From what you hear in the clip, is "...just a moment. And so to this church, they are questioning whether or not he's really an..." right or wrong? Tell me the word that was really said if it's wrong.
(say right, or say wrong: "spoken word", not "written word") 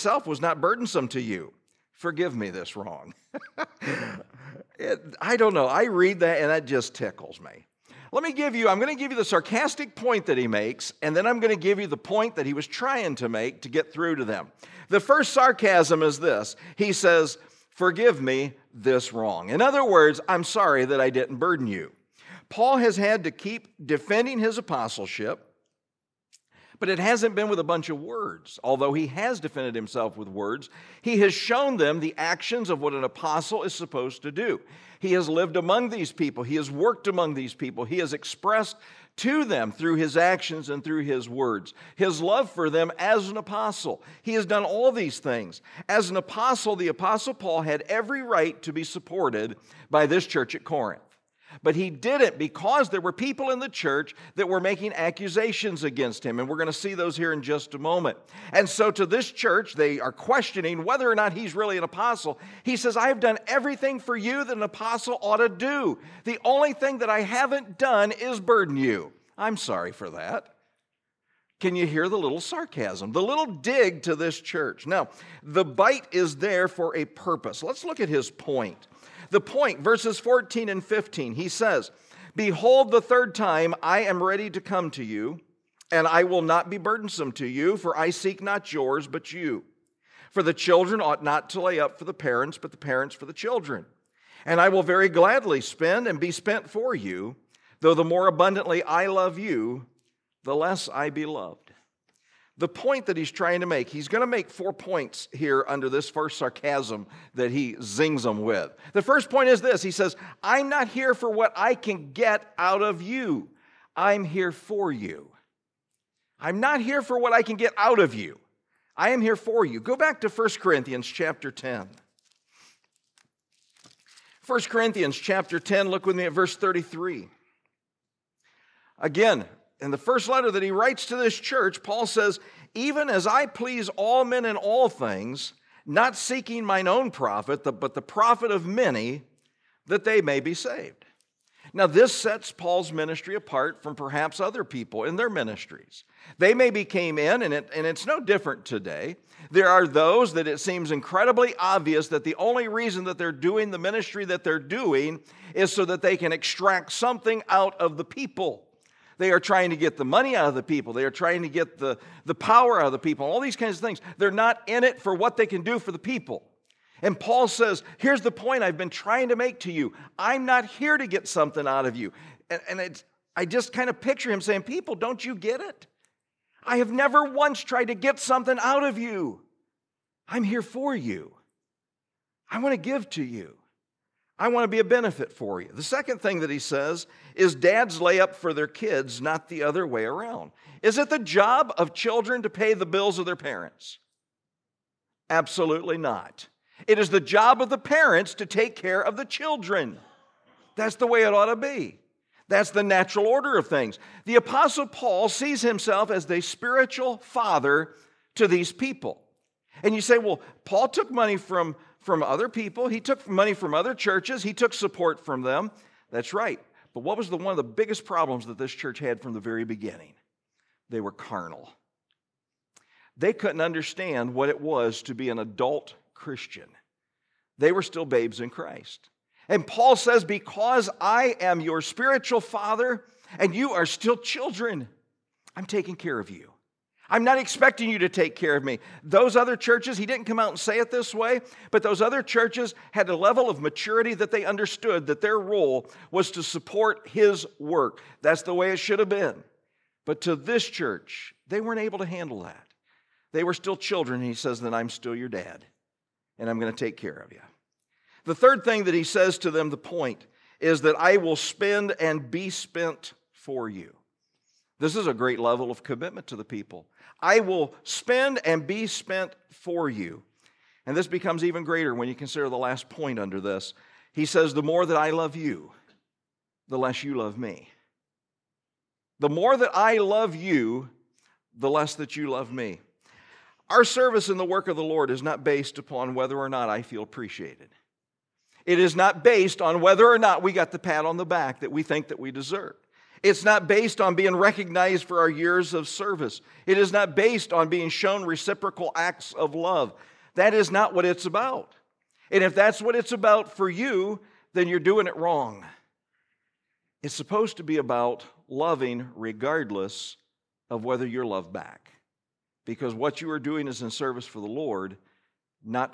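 right.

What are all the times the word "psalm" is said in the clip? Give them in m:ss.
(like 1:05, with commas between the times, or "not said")
not said.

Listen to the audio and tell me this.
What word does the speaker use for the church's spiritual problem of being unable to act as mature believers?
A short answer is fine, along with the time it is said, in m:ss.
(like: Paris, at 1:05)
Carnal, at 3:41.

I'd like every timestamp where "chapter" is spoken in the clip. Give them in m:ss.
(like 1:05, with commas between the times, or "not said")
2:01, 2:05.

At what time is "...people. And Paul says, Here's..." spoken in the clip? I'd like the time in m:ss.
2:45.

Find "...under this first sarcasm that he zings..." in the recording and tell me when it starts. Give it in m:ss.
1:45.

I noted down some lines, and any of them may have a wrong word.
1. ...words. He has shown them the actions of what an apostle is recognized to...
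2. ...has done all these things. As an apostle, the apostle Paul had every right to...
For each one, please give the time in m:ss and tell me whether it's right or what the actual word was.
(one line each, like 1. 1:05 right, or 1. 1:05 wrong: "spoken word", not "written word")
1. 0:30 wrong: "supposed", not "recognized"
2. 0:44 right.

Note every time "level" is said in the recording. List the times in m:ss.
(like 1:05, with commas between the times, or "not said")
4:03, 4:25.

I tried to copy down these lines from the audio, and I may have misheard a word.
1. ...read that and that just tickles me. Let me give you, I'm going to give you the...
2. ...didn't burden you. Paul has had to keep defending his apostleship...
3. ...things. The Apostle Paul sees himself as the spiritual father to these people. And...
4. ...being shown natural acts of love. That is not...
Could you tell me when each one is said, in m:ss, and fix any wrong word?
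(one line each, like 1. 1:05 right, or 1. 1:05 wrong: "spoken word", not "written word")
1. 0:05 right
2. 0:21 right
3. 3:23 right
4. 4:57 wrong: "reciprocal", not "natural".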